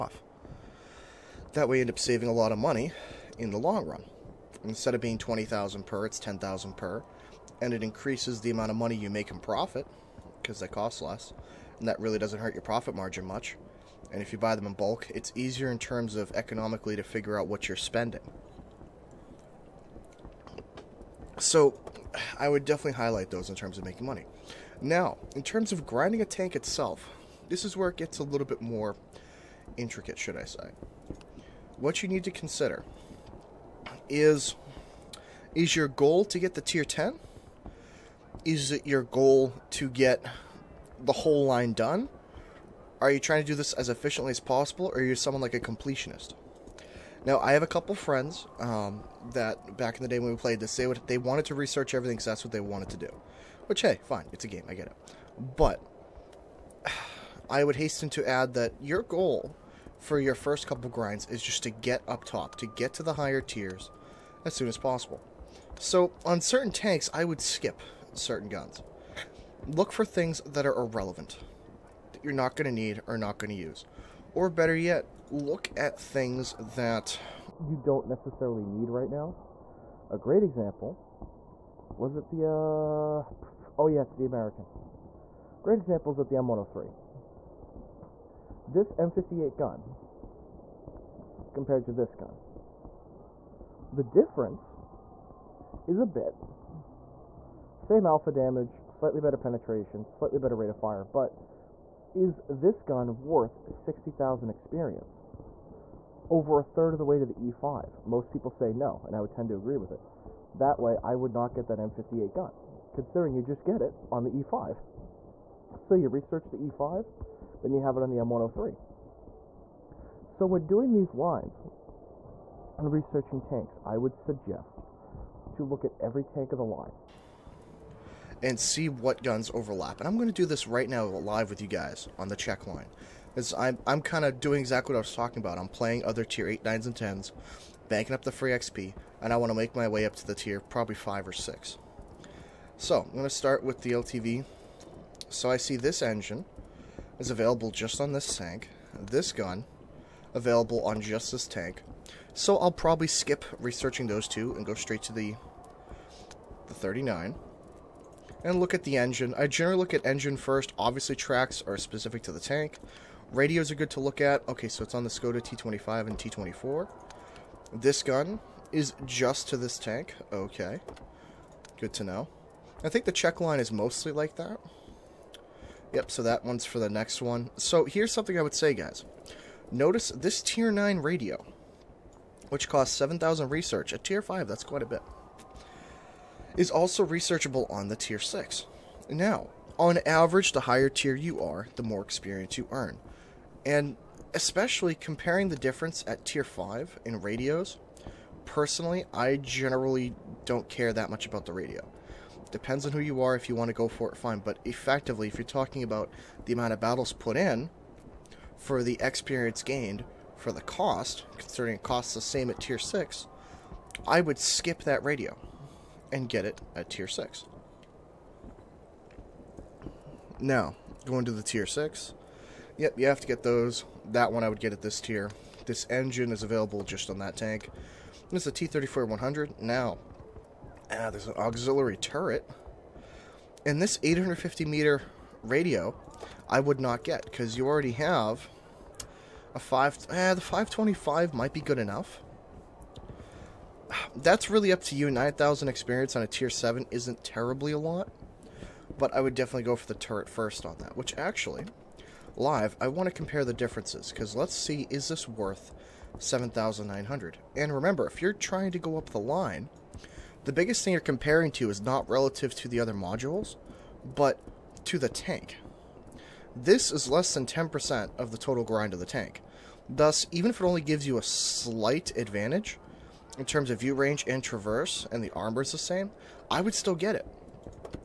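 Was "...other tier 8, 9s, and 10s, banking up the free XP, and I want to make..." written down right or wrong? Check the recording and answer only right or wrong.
right.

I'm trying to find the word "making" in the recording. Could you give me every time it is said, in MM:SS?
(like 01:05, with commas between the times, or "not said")
00:23.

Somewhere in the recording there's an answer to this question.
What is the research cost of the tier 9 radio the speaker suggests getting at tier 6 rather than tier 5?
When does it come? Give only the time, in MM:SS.
03:02.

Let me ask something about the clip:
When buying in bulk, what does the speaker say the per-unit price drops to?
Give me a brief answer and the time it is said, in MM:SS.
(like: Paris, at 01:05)
10,000, at 00:06.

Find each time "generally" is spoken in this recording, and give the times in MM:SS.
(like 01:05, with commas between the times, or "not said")
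02:39, 03:19.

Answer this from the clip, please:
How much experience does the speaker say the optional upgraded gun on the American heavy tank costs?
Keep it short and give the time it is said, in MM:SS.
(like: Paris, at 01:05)
60,000, at 01:43.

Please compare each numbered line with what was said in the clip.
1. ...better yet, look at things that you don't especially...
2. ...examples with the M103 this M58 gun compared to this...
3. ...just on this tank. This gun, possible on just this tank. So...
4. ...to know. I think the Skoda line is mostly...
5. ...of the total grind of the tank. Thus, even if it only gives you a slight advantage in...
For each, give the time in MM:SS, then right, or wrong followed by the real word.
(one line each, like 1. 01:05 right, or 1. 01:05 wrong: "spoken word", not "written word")
1. 01:14 wrong: "necessarily", not "especially"
2. 01:25 right
3. 02:27 wrong: "available", not "possible"
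4. 02:51 wrong: "Czech", not "Skoda"
5. 04:28 right.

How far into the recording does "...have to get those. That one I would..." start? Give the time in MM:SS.
03:43.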